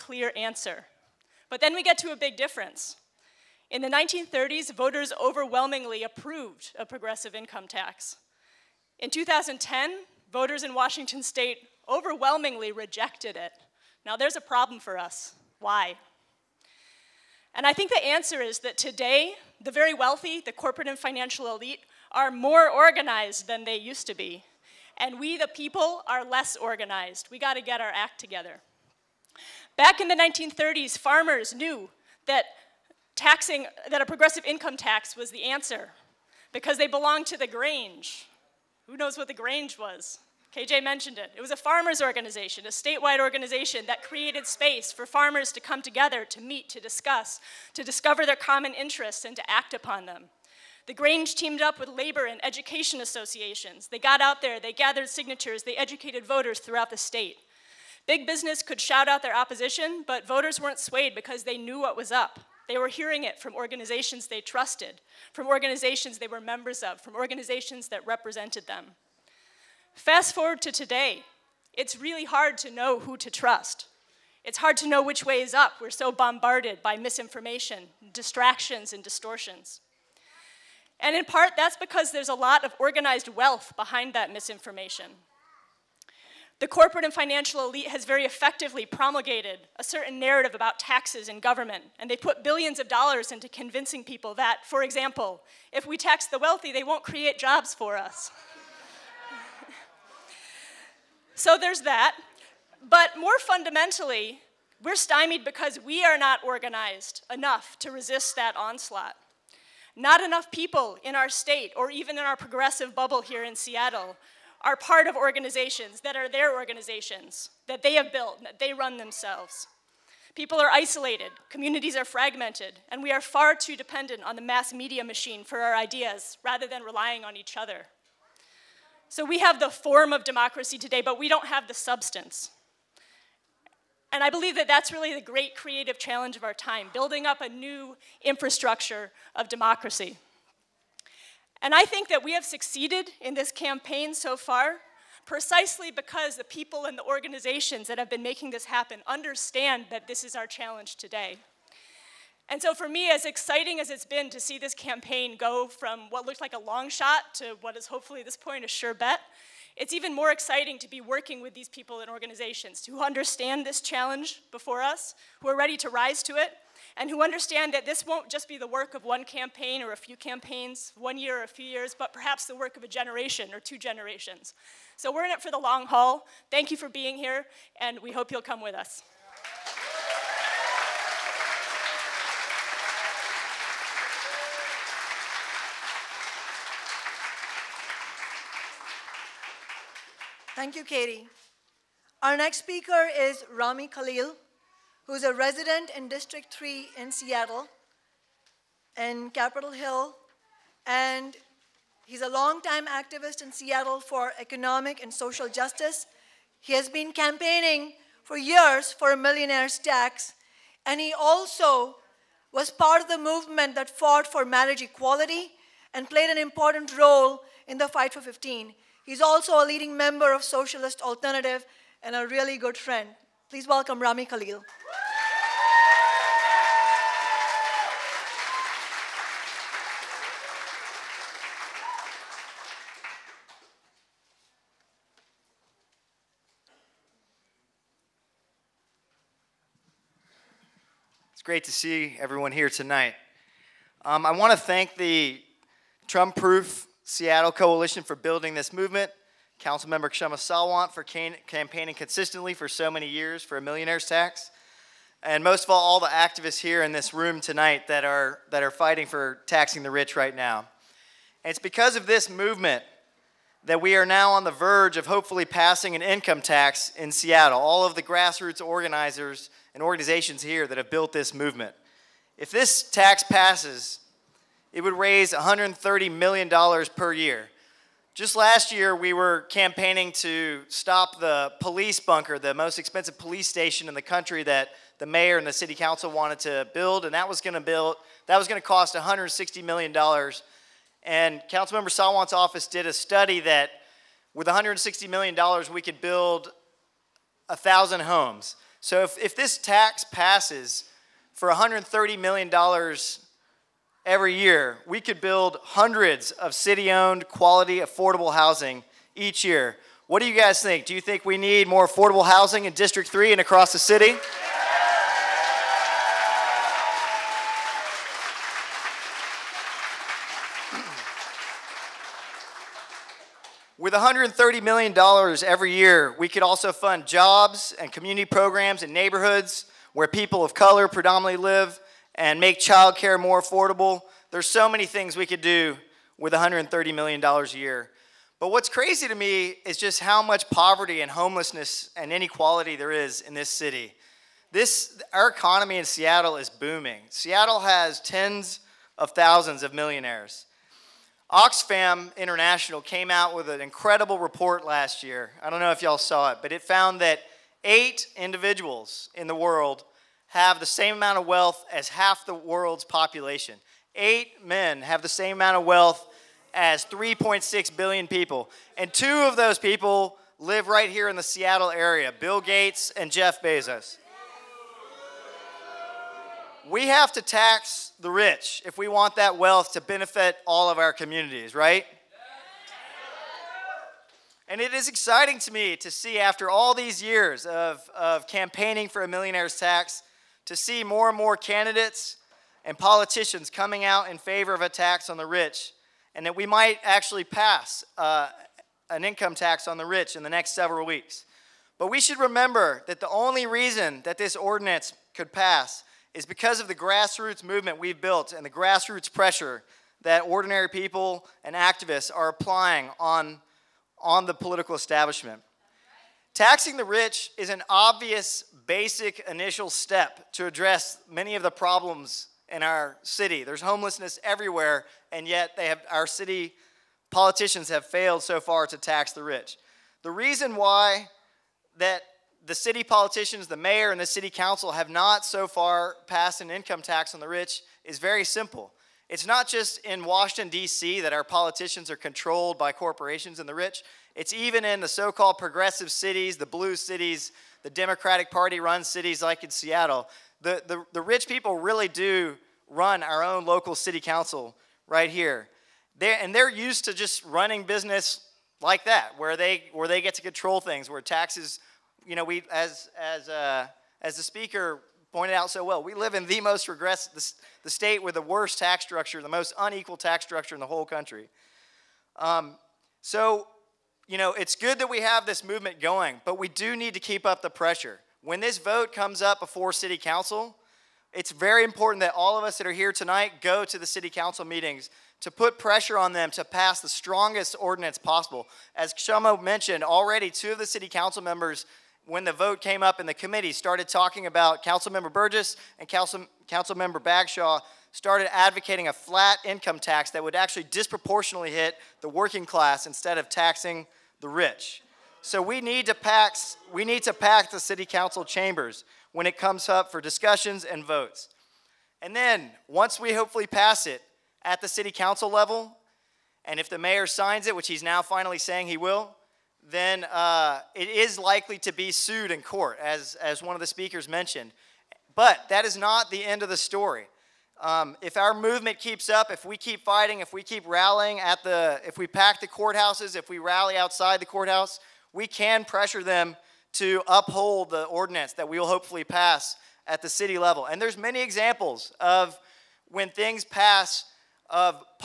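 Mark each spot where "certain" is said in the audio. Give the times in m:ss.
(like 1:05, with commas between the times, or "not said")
1:29.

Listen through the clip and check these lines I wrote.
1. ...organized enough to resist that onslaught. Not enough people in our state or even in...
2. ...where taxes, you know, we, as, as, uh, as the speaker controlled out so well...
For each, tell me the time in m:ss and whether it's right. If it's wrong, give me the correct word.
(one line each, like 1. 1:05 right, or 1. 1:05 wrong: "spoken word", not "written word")
1. 1:46 right
2. 7:40 wrong: "pointed", not "controlled".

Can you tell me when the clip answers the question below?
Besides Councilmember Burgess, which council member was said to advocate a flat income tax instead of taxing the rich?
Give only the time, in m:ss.
8:16.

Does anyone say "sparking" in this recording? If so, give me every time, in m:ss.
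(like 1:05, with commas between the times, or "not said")
not said.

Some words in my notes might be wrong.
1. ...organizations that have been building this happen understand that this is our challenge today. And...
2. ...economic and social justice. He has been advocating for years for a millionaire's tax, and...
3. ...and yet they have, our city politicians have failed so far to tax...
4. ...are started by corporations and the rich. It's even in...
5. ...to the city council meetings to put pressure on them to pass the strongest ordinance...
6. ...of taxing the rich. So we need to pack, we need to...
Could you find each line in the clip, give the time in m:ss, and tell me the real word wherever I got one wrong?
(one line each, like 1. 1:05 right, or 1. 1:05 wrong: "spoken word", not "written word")
1. 2:27 wrong: "making", not "building"
2. 3:24 wrong: "campaigning", not "advocating"
3. 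7:05 right
4. 7:21 wrong: "controlled", not "started"
5. 8:03 right
6. 8:23 right.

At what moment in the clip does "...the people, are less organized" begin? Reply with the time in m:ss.
0:25.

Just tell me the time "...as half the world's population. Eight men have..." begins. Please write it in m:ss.
6:01.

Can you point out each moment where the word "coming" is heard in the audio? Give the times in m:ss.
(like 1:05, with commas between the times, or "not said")
6:33.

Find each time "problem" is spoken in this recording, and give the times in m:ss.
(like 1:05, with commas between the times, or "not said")
0:14, 7:01.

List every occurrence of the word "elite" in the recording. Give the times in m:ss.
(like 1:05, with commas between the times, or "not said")
0:21, 1:27.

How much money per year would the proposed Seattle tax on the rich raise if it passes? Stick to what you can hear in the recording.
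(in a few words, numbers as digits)
$130 million.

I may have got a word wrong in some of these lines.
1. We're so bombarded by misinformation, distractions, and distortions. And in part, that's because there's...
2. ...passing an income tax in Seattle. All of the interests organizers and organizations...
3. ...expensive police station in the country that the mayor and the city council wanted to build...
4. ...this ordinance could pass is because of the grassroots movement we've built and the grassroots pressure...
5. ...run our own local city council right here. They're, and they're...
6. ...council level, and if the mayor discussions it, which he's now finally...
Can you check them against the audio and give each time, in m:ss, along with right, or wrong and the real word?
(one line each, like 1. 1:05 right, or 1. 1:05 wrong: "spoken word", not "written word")
1. 1:15 right
2. 4:25 wrong: "grassroots", not "interests"
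3. 4:42 right
4. 6:44 right
5. 7:32 right
6. 8:34 wrong: "signs", not "discussions".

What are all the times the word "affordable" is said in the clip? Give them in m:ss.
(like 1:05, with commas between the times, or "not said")
5:07, 5:11, 5:33.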